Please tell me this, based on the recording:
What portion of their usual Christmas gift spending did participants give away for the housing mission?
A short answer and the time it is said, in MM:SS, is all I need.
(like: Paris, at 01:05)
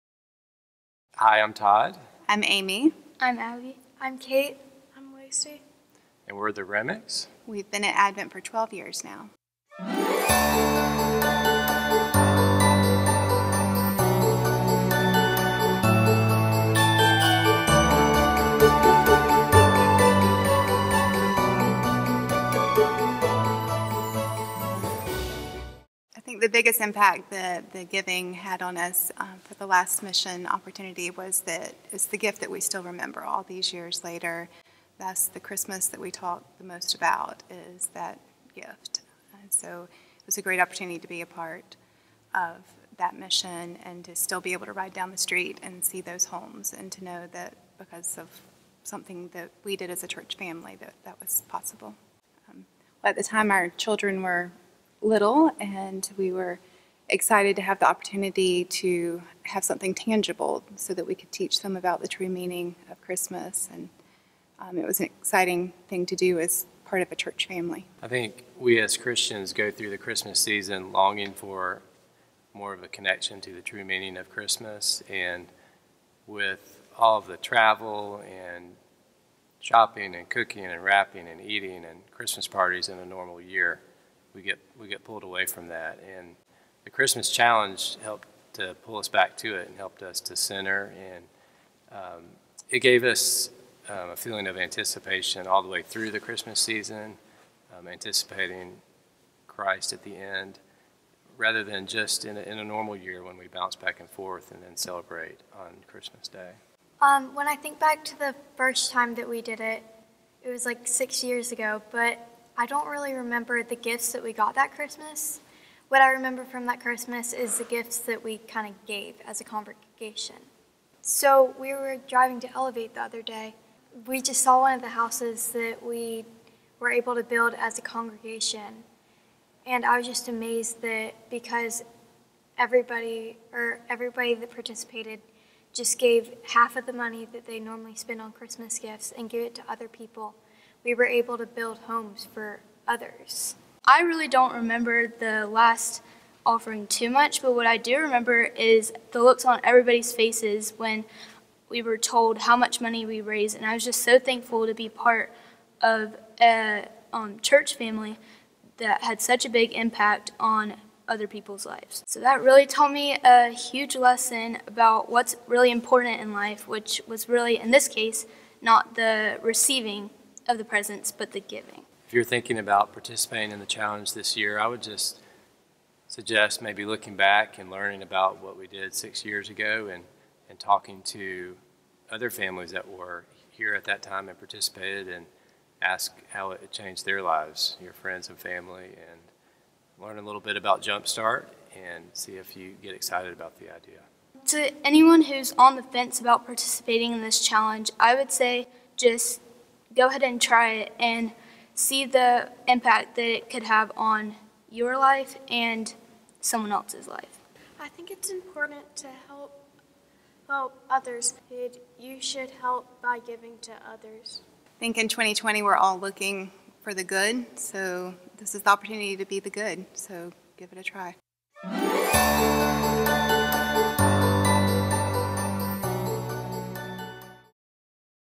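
half, at 02:16.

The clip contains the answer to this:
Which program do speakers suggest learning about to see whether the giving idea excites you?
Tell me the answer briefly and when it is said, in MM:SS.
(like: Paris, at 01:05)
Jumpstart, at 03:10.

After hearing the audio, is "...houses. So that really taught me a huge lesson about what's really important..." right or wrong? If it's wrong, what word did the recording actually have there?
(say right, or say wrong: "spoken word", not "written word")
wrong: "lives", not "houses".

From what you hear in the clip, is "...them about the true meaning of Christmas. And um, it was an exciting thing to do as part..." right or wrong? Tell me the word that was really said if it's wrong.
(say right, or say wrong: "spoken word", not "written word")
right.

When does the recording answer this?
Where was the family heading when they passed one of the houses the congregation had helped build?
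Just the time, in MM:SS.
02:02.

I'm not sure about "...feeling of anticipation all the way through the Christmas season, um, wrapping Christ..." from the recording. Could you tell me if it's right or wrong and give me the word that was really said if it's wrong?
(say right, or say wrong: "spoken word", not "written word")
wrong: "anticipating", not "wrapping".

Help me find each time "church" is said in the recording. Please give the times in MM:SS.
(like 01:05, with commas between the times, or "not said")
00:50, 01:07, 02:37.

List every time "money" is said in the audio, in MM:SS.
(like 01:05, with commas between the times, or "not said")
02:16, 02:32.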